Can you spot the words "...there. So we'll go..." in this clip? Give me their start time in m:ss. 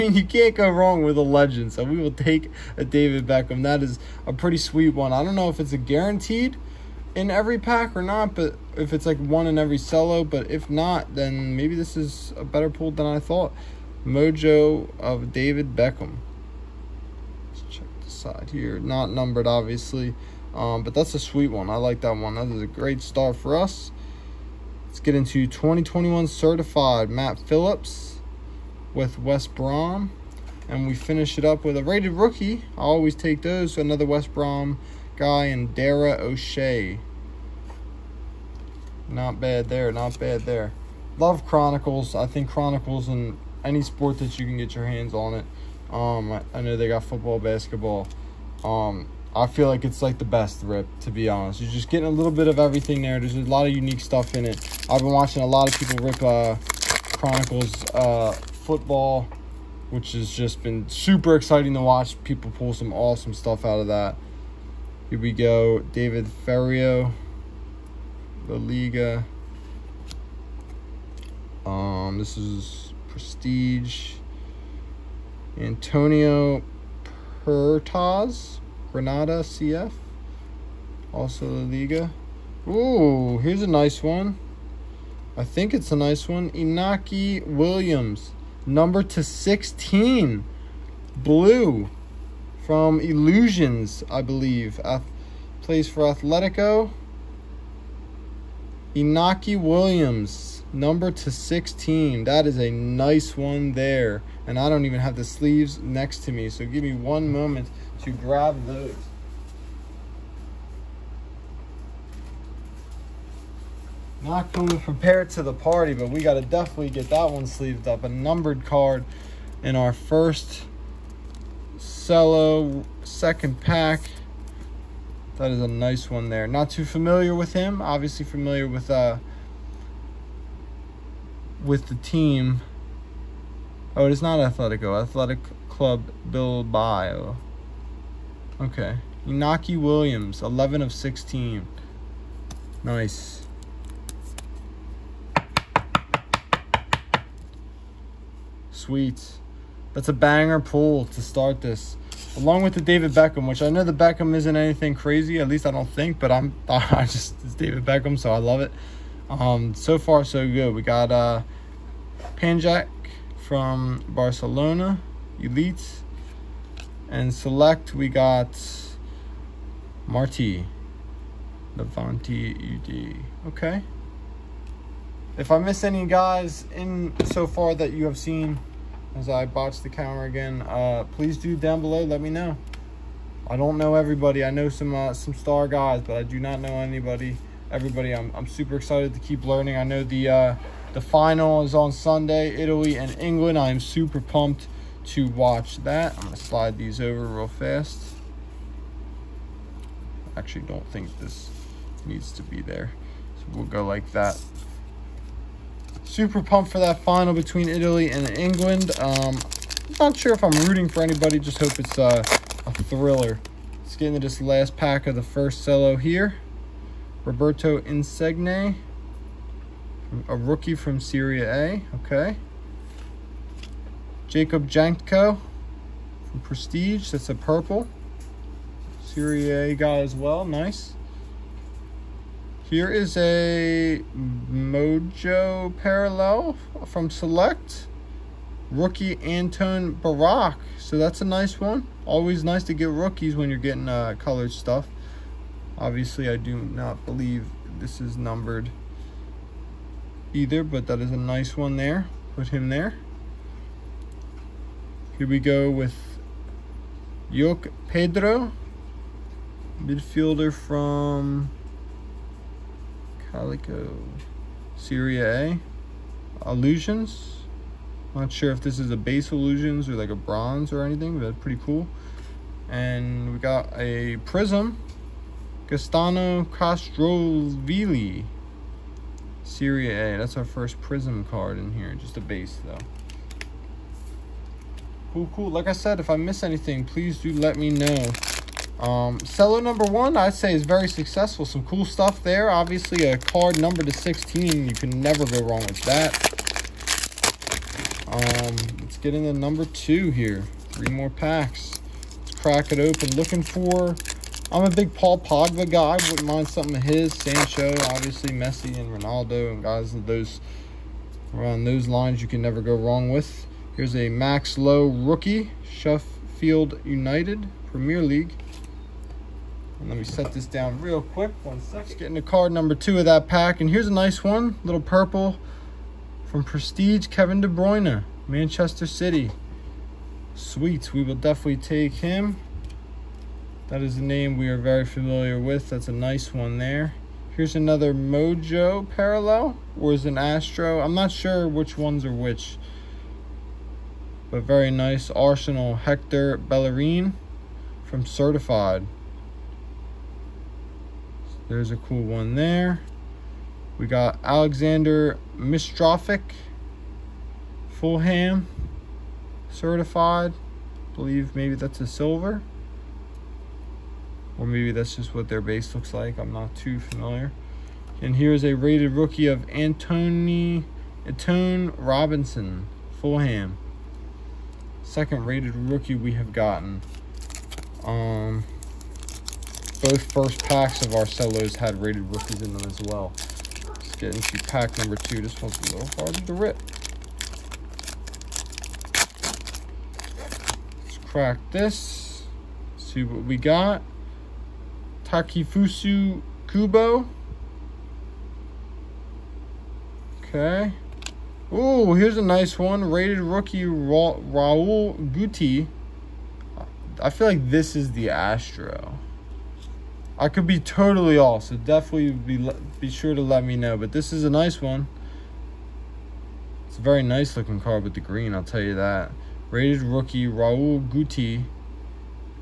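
3:22.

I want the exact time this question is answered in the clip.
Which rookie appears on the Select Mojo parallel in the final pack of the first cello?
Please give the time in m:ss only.
3:59.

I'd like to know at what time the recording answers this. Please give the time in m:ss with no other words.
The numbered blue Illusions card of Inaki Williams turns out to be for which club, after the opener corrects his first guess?
2:14.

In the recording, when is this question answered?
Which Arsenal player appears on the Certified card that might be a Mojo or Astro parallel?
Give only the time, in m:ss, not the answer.
5:45.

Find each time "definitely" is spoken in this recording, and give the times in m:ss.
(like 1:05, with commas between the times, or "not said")
1:56, 5:31, 6:51.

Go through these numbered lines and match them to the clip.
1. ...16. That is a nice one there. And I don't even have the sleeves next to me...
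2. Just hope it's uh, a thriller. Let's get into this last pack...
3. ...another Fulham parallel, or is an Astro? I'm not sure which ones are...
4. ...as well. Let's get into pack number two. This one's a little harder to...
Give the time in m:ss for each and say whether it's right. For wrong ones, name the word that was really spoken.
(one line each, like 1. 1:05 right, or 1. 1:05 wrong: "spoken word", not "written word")
1. 1:41 right
2. 3:31 right
3. 5:37 wrong: "Mojo", not "Fulham"
4. 6:22 right.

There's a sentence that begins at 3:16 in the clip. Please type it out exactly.
I'm going to slide these over real fast.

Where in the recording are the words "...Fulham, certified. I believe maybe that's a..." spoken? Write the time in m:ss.
5:57.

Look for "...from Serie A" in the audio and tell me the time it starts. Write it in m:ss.
3:40.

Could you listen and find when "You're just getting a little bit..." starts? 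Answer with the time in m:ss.
0:51.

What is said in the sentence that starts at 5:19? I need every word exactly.
And let me set this down real quick, one second.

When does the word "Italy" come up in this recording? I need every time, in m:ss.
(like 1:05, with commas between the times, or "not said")
3:12, 3:27.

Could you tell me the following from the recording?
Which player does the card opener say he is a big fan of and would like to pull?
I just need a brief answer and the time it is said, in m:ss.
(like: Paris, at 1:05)
Paul Pogba, at 5:04.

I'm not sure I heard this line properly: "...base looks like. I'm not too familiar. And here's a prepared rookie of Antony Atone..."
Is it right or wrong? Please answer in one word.
wrong.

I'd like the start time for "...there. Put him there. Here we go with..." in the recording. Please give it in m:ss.
4:11.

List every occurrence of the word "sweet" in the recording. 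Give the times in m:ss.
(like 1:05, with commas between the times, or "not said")
0:04, 0:21, 2:28, 5:30.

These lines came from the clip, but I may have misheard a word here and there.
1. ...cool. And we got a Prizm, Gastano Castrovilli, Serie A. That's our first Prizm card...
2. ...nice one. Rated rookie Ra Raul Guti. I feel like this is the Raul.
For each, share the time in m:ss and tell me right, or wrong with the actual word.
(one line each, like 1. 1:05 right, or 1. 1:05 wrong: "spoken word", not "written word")
1. 4:31 right
2. 6:42 wrong: "Astro", not "Raul".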